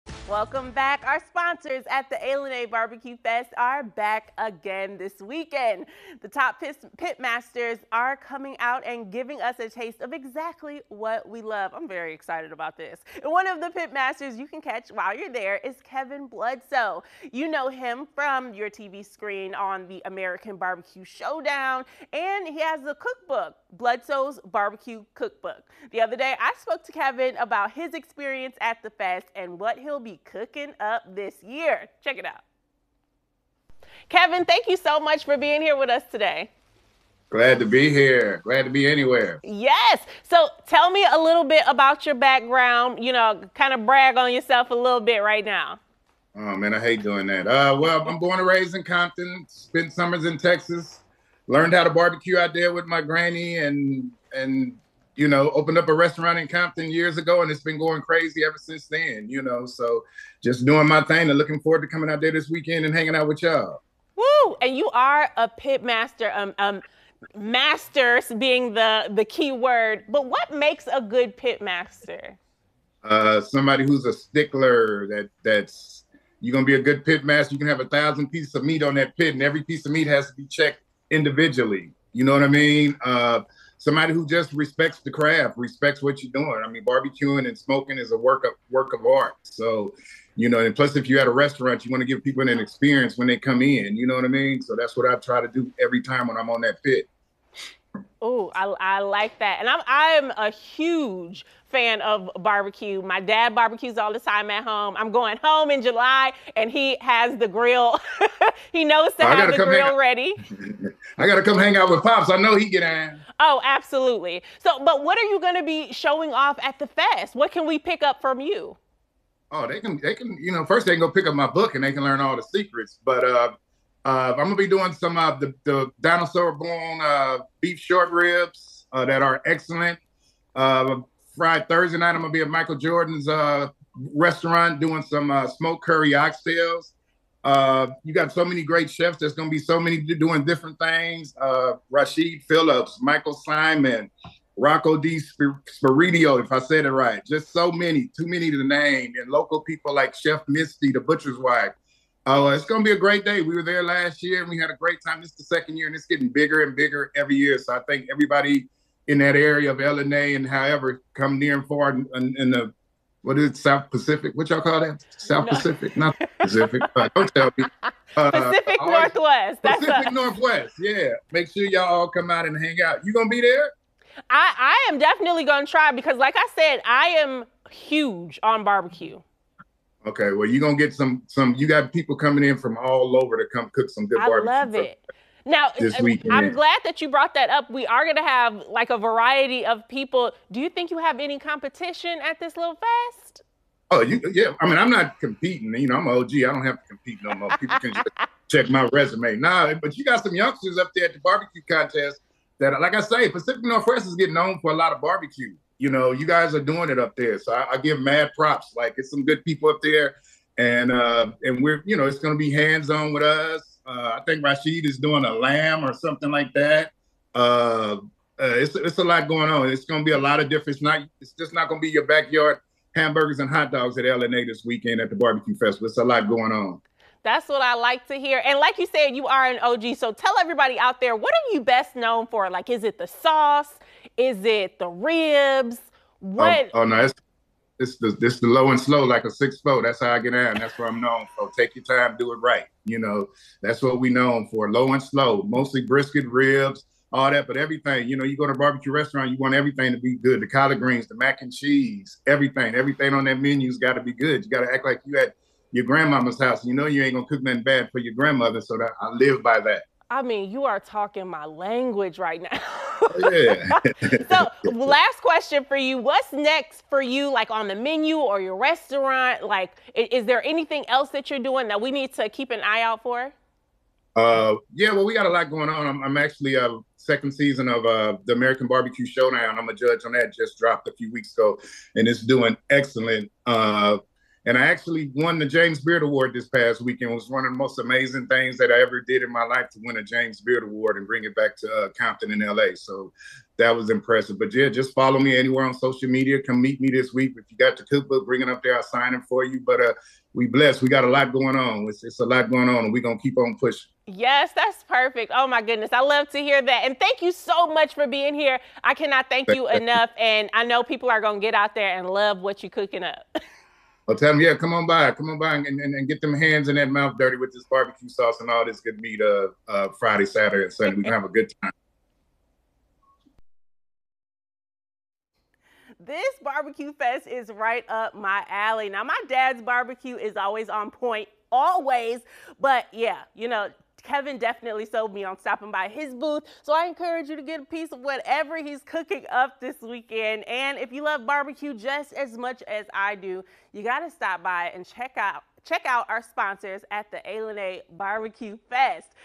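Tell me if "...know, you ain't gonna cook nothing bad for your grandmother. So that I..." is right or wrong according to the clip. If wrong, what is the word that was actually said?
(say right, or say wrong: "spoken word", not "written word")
right.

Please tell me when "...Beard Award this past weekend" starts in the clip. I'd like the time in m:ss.
4:45.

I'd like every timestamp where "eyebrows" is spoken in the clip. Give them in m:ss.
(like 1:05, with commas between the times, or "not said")
not said.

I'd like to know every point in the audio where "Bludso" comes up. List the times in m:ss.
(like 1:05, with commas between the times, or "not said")
0:16, 0:23.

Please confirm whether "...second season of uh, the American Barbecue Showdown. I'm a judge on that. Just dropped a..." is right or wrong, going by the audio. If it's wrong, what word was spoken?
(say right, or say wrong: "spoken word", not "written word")
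right.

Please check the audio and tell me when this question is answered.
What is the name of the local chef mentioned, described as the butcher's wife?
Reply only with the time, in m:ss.
2:30.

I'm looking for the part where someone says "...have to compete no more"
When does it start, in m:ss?
3:16.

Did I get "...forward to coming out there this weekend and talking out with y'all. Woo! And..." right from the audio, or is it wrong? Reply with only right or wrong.
wrong.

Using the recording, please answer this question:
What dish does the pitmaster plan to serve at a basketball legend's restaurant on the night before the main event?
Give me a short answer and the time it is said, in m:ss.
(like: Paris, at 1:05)
Smoked curry oxtails, at 2:15.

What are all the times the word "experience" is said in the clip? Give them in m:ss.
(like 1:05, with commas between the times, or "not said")
0:27, 1:32.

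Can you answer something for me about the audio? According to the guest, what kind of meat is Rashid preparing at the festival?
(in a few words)
Lamb.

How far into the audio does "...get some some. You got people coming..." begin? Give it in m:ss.
3:00.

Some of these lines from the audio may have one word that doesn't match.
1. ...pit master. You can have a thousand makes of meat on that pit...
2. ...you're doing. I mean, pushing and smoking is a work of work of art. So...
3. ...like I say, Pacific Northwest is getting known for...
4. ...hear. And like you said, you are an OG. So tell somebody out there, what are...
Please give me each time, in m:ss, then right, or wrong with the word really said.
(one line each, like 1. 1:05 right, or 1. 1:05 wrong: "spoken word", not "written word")
1. 1:17 wrong: "pieces", not "makes"
2. 1:26 wrong: "barbecuing", not "pushing"
3. 3:22 right
4. 3:48 wrong: "everybody", not "somebody".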